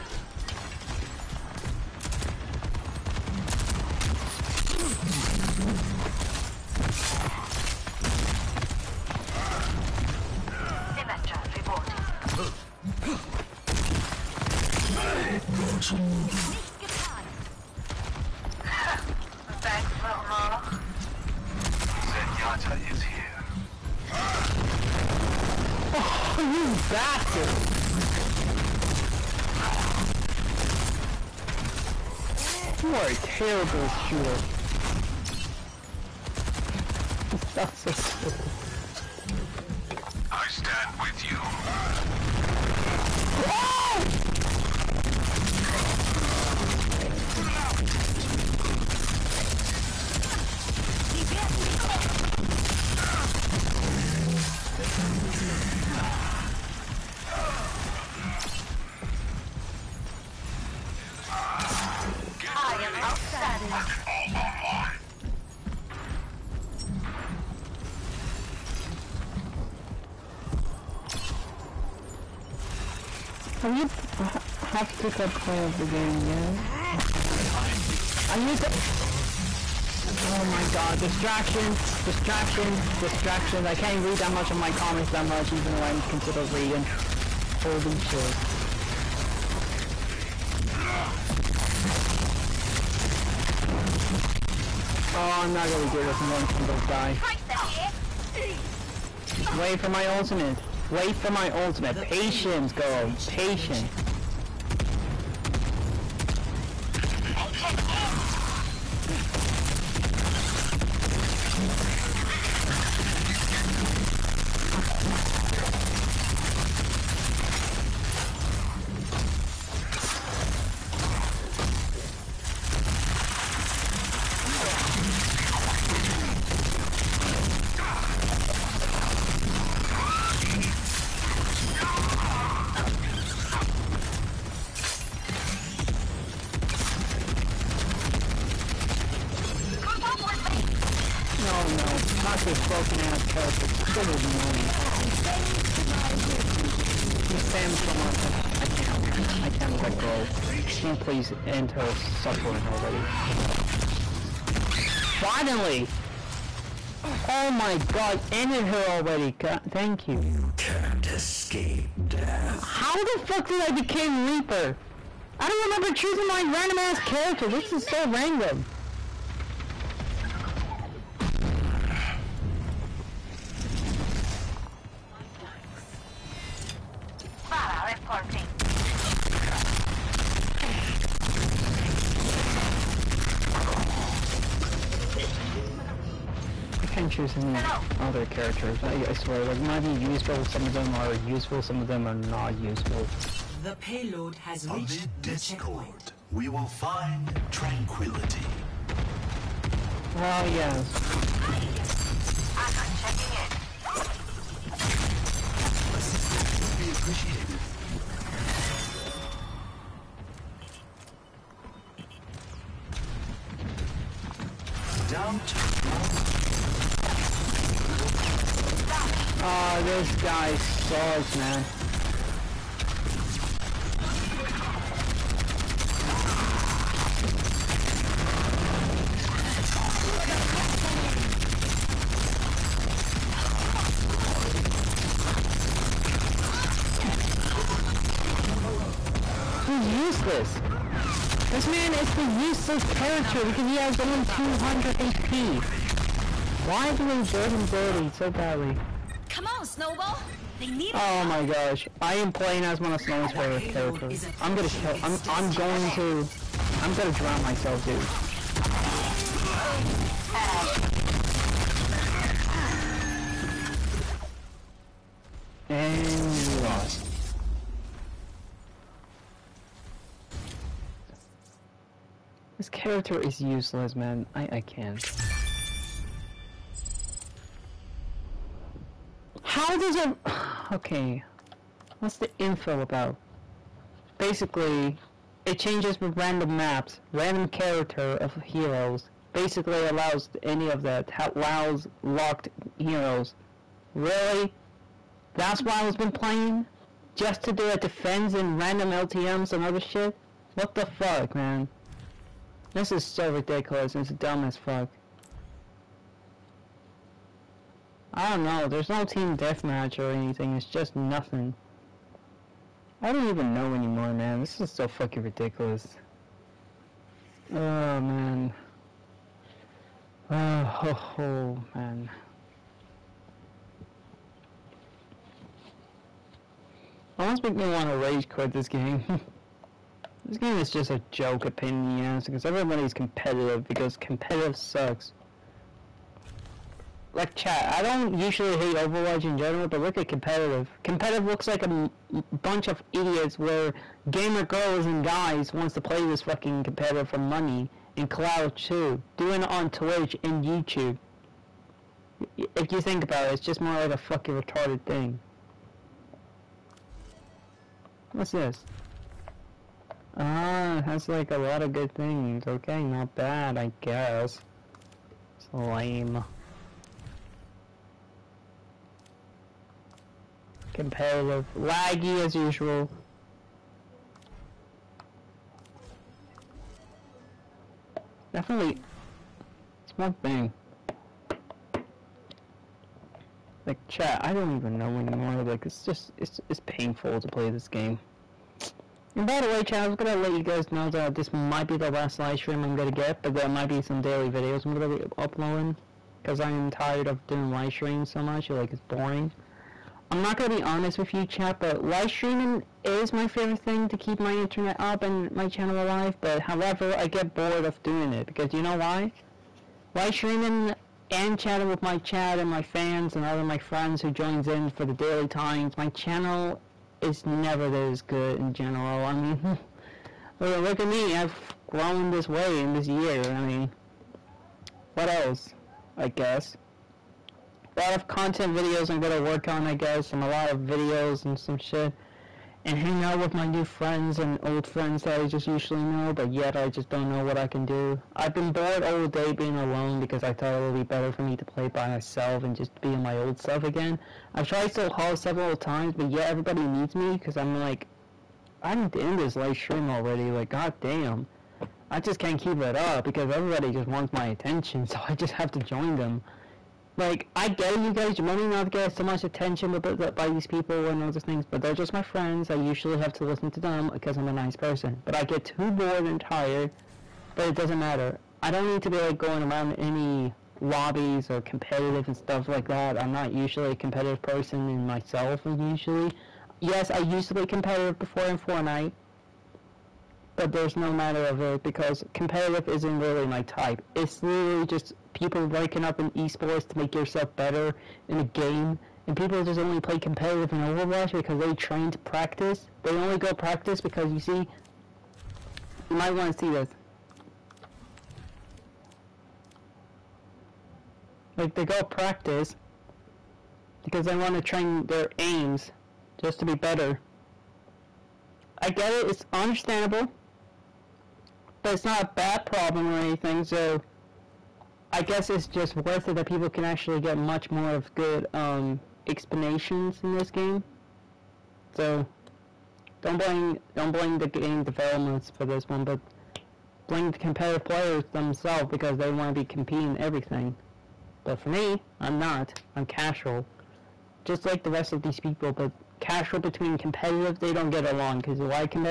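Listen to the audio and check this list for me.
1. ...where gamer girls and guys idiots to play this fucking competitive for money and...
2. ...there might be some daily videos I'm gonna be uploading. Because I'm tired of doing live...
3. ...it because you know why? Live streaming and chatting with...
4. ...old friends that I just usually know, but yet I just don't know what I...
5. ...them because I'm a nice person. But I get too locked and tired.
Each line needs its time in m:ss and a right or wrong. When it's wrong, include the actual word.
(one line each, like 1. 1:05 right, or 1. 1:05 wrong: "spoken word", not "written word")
1. 5:43 wrong: "wants", not "idiots"
2. 6:33 right
3. 6:48 right
4. 7:14 right
5. 7:43 wrong: "bored", not "locked".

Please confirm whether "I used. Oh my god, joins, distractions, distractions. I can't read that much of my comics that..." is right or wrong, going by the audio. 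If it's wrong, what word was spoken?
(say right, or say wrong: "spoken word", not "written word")
wrong: "distractions", not "joins".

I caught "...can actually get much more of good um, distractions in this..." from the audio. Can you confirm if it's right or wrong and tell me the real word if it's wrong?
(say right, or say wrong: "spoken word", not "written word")
wrong: "explanations", not "distractions".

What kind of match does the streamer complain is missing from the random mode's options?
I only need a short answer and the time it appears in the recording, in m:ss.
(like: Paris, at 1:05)
team deathmatch, at 5:09.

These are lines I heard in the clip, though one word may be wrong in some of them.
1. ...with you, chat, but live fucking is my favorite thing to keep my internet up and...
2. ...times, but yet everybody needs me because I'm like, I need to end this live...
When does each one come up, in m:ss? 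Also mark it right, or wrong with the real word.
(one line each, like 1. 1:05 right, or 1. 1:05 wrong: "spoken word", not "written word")
1. 6:40 wrong: "streaming", not "fucking"
2. 7:25 right.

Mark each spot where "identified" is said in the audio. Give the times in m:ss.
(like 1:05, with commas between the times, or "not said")
not said.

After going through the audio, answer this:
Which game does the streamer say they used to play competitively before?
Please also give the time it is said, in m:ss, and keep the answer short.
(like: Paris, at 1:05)
Fortnite, at 7:58.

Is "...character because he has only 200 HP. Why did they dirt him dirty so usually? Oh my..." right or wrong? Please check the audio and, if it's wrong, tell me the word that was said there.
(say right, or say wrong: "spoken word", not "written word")
wrong: "badly", not "usually".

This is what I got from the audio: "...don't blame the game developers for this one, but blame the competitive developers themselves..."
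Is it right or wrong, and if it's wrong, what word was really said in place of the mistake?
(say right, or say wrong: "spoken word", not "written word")
wrong: "players", not "developers".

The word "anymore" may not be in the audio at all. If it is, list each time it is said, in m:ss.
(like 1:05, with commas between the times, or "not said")
5:13, 6:24.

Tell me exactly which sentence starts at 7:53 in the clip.
I'm not usually a competitive person in myself.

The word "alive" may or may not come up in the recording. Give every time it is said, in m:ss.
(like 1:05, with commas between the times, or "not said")
6:45.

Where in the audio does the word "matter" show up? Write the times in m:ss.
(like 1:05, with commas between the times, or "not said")
7:47, 8:00.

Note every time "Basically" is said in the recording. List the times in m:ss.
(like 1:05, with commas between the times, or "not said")
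4:44, 4:49.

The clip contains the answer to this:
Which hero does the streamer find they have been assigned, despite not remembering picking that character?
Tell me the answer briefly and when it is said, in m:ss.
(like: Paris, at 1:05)
Reaper, at 2:44.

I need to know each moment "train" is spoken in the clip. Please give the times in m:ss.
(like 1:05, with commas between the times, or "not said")
8:11, 8:24.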